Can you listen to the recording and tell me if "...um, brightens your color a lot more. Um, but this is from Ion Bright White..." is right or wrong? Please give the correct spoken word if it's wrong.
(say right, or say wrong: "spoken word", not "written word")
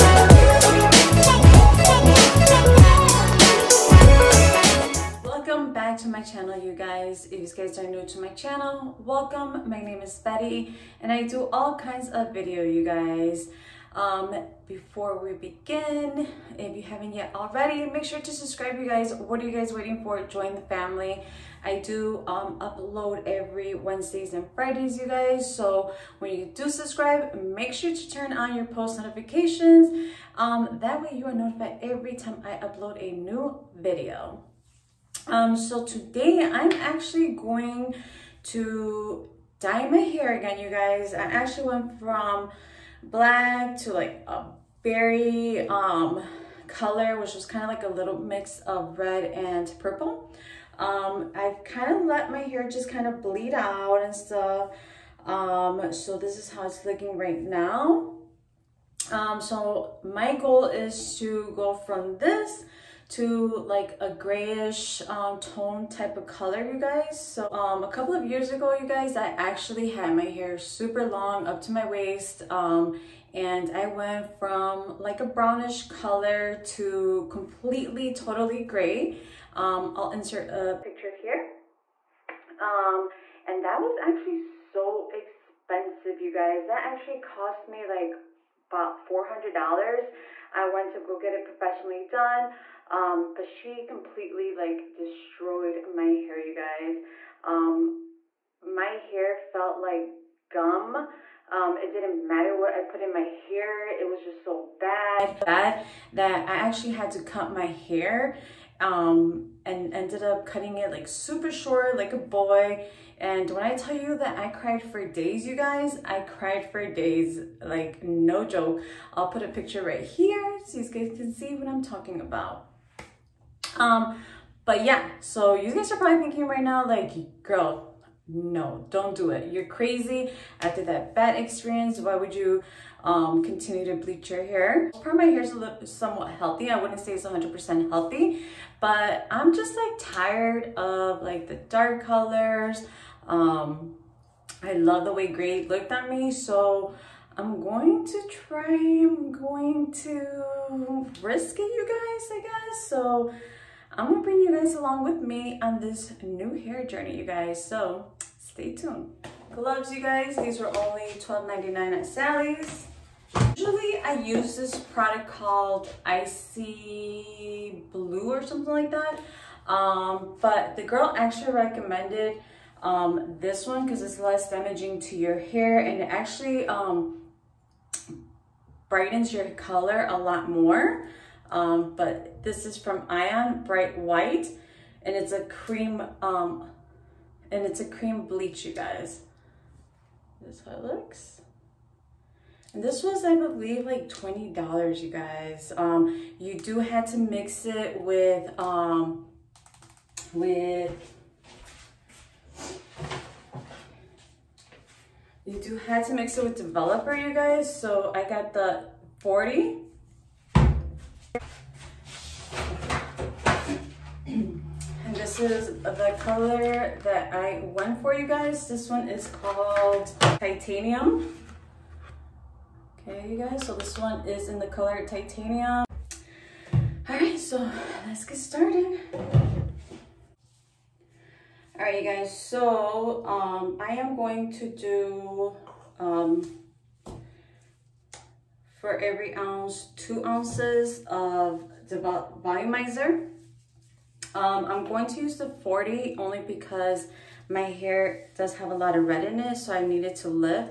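right.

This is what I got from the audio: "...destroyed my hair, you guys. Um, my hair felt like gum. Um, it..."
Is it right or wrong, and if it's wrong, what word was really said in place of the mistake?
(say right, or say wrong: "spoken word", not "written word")
right.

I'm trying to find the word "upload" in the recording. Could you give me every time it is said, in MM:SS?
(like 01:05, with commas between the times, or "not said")
00:22, 00:32.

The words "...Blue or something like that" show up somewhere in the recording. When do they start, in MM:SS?
02:47.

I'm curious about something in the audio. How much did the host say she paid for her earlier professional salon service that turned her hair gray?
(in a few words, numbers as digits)
$400.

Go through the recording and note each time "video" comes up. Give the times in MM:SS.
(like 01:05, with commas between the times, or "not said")
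00:12, 00:33.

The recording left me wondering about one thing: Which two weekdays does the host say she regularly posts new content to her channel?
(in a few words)
Wednesdays and Fridays.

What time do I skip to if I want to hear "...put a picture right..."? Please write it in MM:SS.
01:59.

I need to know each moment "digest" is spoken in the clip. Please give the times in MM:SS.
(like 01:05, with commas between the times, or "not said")
not said.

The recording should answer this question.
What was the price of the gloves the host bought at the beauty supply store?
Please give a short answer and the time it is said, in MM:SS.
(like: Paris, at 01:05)
$12.99, at 02:41.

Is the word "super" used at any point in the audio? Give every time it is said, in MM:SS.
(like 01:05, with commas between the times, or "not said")
01:10, 01:51.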